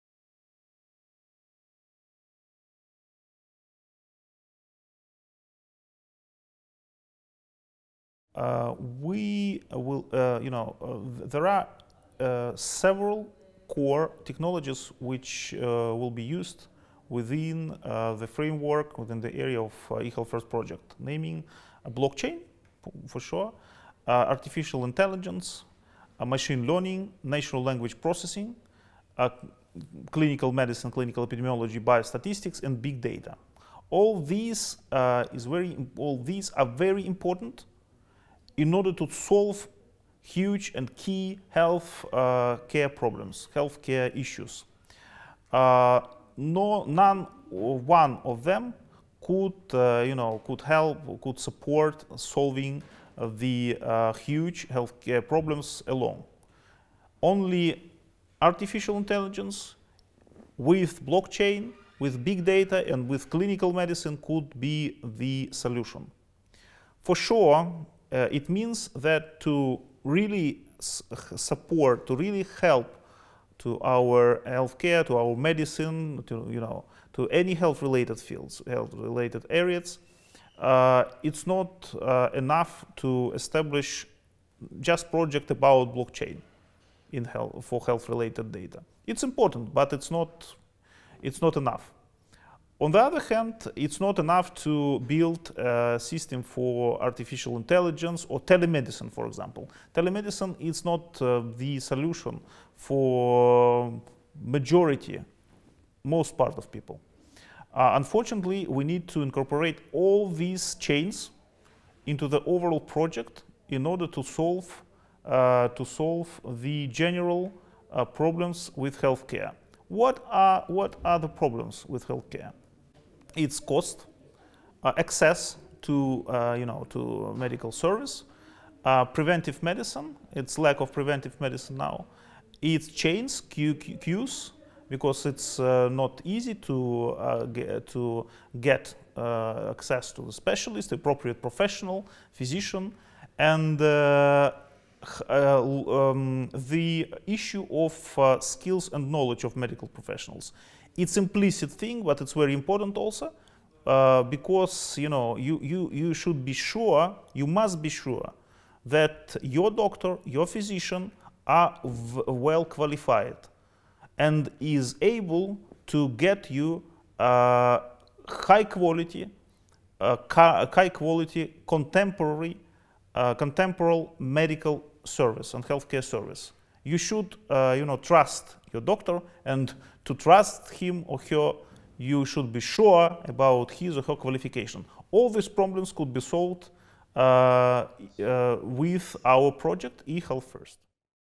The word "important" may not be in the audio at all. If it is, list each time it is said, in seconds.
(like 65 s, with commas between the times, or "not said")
37 s, 89 s, 152 s.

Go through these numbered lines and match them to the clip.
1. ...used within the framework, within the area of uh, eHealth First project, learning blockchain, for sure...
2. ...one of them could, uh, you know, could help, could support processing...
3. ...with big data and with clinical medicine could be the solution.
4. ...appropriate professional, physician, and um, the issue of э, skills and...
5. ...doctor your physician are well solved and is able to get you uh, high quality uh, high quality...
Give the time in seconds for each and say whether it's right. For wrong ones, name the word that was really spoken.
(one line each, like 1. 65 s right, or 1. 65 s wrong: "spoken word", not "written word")
1. 16 s wrong: "naming", not "learning"
2. 47 s wrong: "solving", not "processing"
3. 61 s right
4. 140 s right
5. 159 s wrong: "qualified", not "solved".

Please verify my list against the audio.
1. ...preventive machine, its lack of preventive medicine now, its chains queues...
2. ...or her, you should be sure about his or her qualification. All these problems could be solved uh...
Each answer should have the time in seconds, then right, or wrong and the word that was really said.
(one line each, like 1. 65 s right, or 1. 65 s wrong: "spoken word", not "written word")
1. 129 s wrong: "medicine", not "machine"
2. 181 s right.